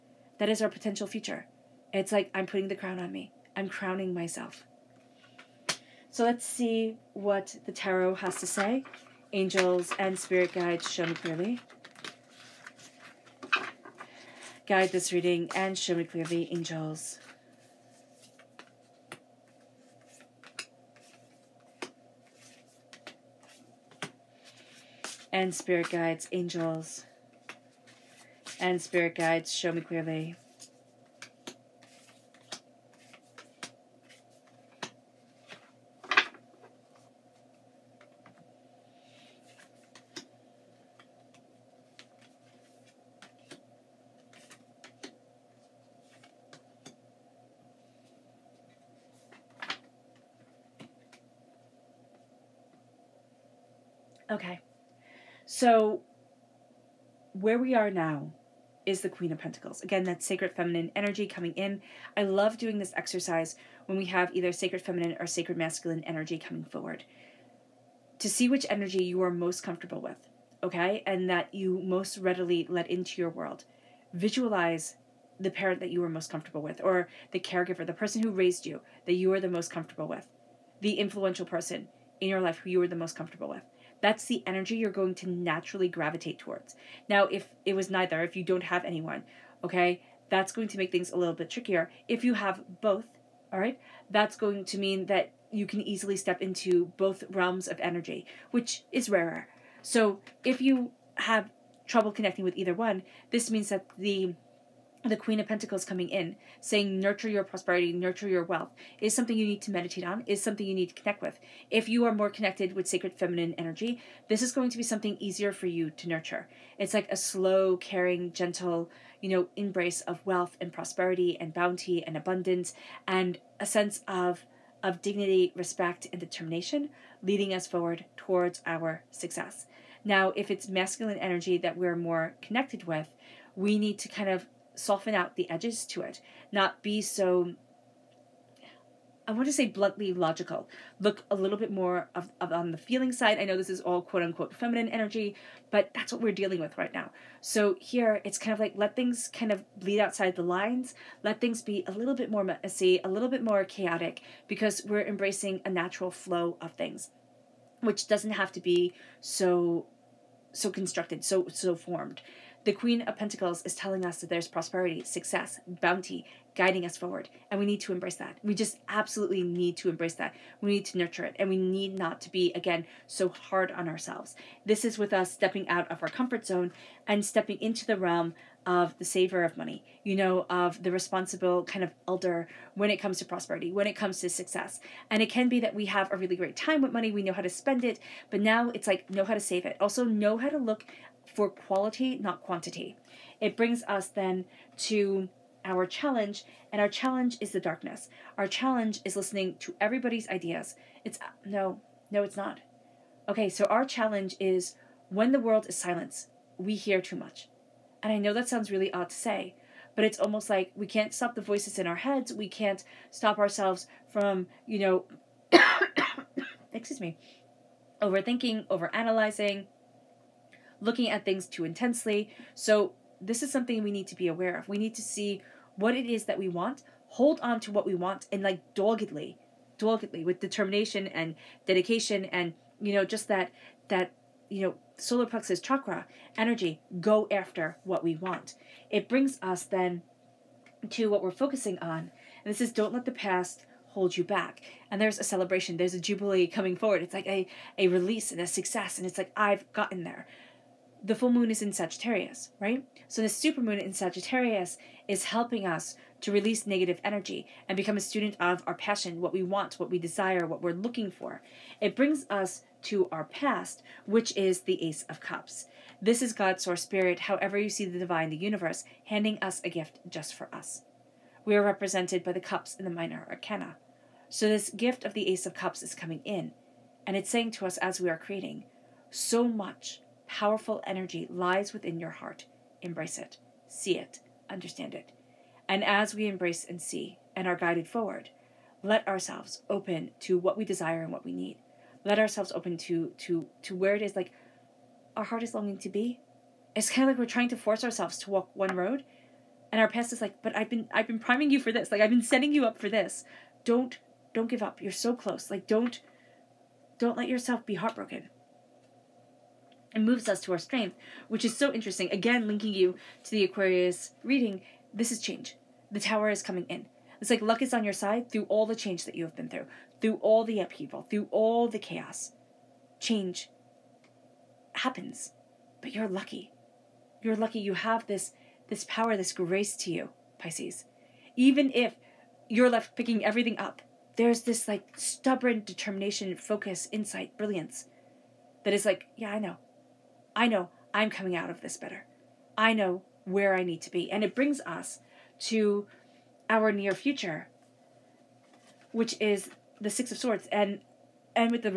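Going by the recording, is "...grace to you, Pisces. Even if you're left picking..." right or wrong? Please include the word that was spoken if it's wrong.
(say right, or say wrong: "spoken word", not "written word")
right.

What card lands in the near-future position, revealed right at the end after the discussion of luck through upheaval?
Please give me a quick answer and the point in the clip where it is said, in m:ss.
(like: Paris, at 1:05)
Six of Swords, at 5:49.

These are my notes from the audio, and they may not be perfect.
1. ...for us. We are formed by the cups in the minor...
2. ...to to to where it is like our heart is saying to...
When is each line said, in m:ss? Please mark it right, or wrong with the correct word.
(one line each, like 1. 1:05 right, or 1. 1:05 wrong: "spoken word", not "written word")
1. 4:30 wrong: "represented", not "formed"
2. 4:52 wrong: "longing", not "saying".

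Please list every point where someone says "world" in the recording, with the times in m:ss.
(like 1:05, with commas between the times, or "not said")
1:13, 3:25.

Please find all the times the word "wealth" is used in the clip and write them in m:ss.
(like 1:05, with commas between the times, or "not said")
1:48, 2:00.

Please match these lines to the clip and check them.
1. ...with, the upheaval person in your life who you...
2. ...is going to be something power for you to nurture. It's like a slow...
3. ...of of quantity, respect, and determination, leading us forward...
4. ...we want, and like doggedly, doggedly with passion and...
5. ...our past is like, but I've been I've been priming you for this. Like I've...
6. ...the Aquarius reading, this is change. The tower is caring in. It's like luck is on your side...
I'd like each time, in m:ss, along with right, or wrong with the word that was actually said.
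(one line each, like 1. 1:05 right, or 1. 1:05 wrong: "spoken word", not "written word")
1. 1:20 wrong: "influential", not "upheaval"
2. 1:54 wrong: "easier", not "power"
3. 2:04 wrong: "dignity", not "quantity"
4. 3:47 wrong: "determination", not "passion"
5. 4:59 right
6. 5:13 wrong: "coming", not "caring".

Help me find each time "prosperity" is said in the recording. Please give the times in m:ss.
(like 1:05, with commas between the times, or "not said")
1:47, 2:00, 2:44, 3:03.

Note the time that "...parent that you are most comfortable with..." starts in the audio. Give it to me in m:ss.
1:15.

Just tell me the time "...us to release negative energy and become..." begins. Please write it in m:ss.
4:15.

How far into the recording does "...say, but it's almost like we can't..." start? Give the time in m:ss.
3:29.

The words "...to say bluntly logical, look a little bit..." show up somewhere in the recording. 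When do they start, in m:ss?
2:19.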